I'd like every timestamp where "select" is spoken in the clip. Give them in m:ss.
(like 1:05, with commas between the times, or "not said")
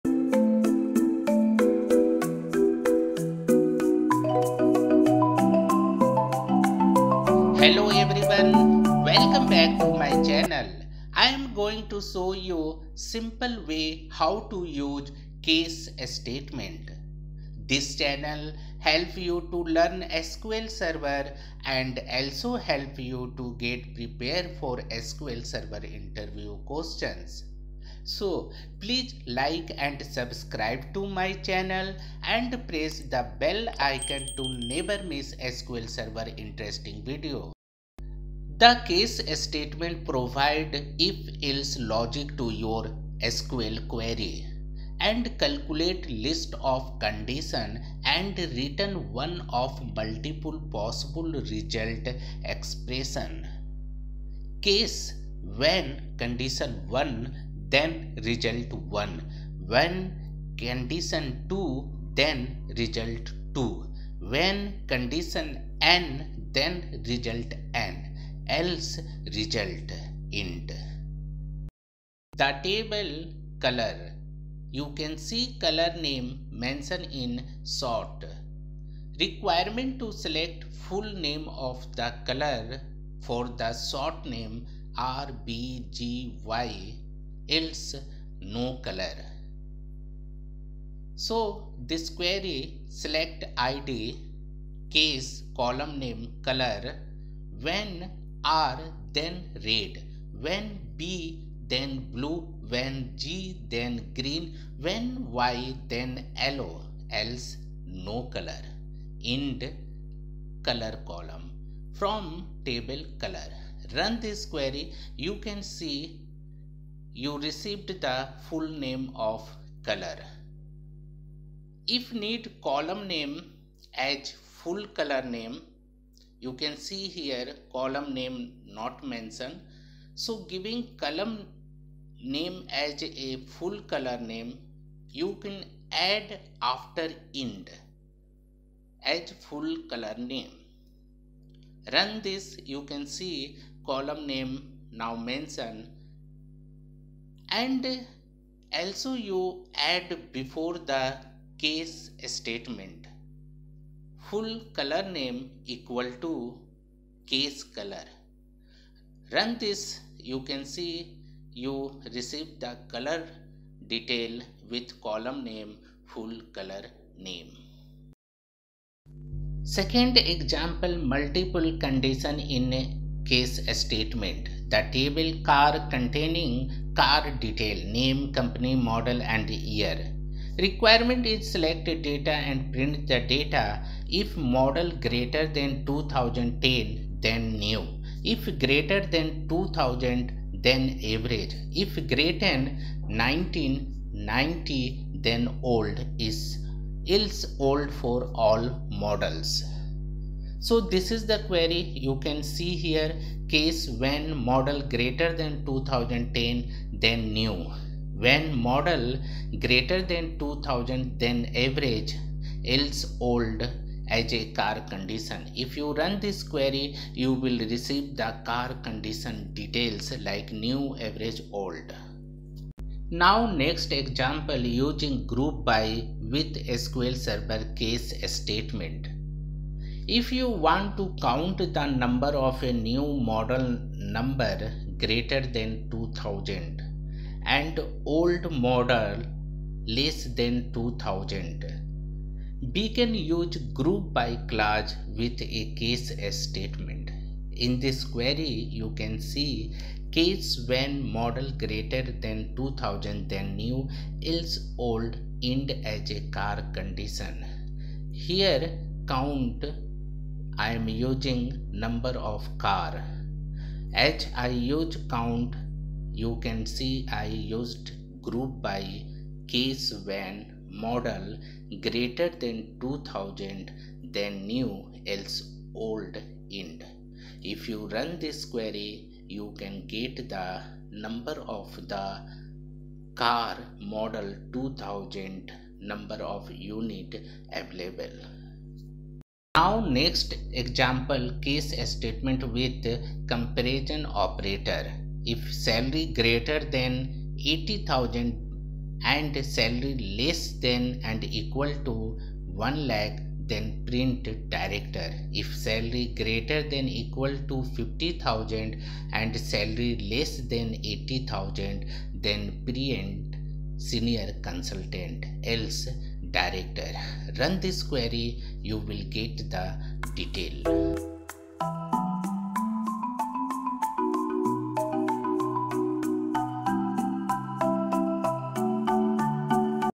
1:20, 1:33, 3:01.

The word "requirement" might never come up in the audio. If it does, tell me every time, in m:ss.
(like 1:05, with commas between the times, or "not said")
1:19, 3:00.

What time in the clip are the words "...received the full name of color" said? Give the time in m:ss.
1:57.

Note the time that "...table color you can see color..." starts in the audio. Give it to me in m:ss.
1:12.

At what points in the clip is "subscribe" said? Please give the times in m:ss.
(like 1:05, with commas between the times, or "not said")
0:30.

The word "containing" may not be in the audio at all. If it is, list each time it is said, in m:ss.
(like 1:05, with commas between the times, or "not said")
2:55.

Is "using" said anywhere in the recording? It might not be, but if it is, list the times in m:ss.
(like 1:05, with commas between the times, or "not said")
3:44, 4:20.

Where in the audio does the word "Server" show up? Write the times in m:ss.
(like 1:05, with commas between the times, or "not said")
0:20, 0:25, 0:35, 3:47.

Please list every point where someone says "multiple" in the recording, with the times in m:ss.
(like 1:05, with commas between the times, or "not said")
0:49, 2:51.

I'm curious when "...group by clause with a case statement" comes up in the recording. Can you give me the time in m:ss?
4:03.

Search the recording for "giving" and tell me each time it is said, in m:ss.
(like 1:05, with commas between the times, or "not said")
2:10.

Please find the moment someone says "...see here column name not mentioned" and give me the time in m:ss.
2:06.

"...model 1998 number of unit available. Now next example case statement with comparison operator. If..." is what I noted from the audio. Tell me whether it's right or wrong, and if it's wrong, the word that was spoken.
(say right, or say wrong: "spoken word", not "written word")
wrong: "2000", not "1998".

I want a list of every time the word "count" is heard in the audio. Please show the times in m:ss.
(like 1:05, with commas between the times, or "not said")
3:51, 4:19, 4:25.